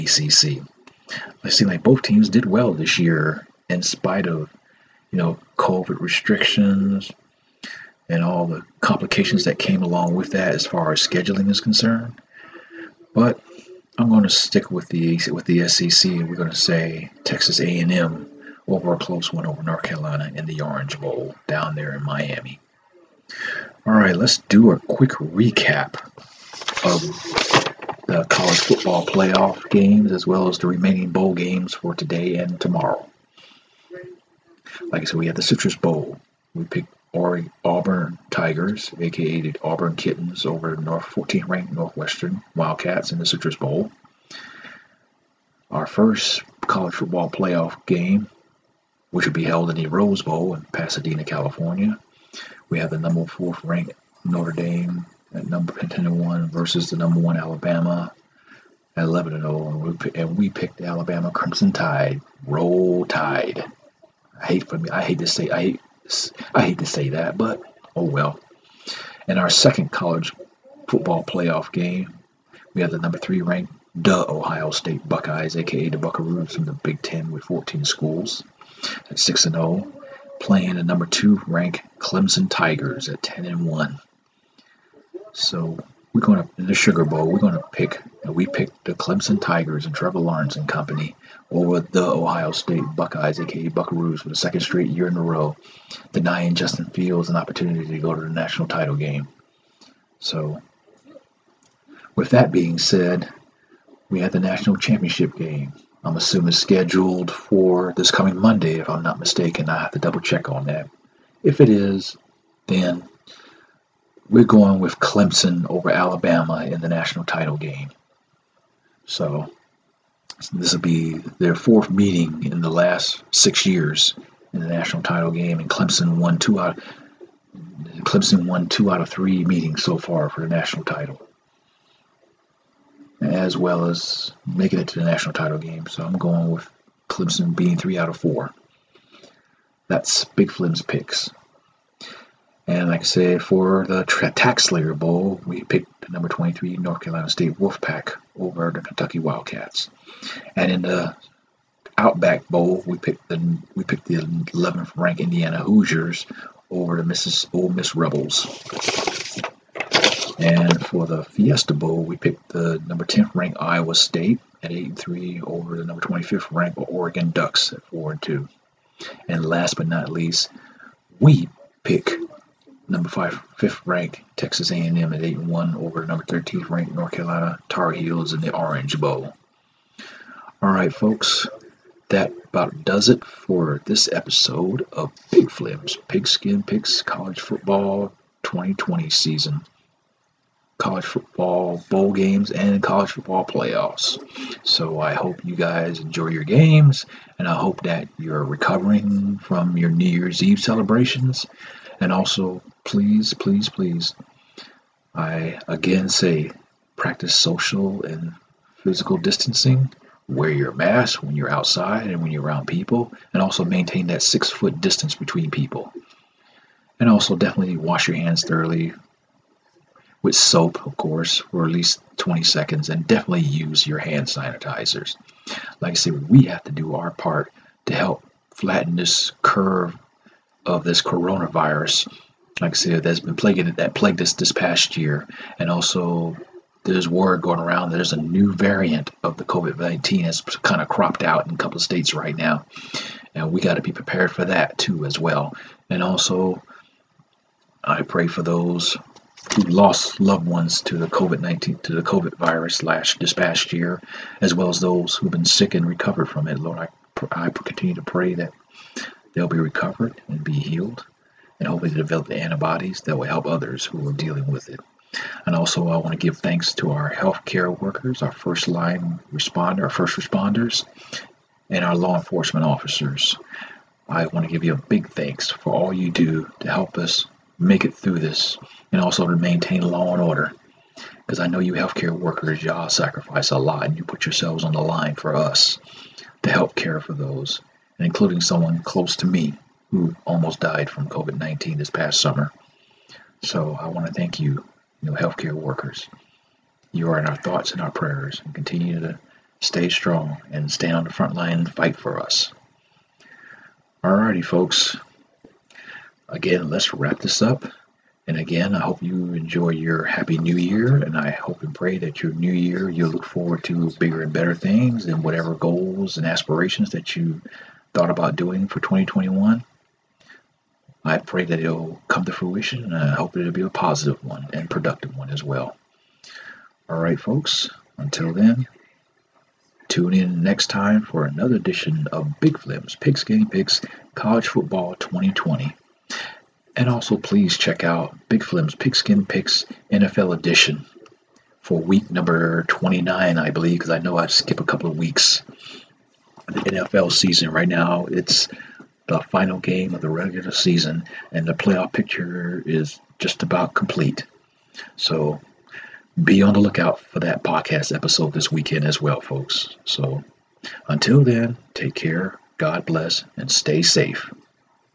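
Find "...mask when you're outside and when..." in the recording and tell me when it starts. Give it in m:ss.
3:30.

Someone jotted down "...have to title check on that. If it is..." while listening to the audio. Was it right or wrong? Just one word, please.
wrong.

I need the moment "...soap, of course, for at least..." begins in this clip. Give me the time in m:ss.
3:40.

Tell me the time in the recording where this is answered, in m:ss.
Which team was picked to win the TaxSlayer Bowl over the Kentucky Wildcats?
2:26.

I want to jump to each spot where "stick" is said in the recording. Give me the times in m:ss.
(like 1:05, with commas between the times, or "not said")
0:14.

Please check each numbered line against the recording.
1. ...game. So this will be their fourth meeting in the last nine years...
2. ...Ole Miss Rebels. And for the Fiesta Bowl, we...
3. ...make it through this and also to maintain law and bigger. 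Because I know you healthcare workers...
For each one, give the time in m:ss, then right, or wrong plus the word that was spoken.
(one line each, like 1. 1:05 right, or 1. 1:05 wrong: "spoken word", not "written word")
1. 1:57 wrong: "six", not "nine"
2. 2:37 right
3. 4:37 wrong: "order", not "bigger".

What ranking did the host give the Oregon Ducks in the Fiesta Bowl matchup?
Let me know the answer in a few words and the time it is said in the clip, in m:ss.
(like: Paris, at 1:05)
25th, at 2:45.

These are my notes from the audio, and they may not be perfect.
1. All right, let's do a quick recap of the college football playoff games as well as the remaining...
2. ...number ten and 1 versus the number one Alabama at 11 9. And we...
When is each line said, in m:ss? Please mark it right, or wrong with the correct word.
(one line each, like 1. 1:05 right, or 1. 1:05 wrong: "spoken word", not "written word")
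1. 0:23 right
2. 0:55 wrong: "0", not "9".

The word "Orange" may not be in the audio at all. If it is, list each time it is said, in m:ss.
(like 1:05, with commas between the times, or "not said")
0:20, 2:58.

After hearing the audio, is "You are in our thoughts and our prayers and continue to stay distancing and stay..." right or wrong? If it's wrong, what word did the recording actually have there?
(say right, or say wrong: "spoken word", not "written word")
wrong: "strong", not "distancing".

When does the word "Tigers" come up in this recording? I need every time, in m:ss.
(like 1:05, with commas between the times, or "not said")
0:38, 1:22, 1:29.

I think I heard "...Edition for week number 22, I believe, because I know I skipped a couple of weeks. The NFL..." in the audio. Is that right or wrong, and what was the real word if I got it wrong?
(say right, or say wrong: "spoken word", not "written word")
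wrong: "29", not "22".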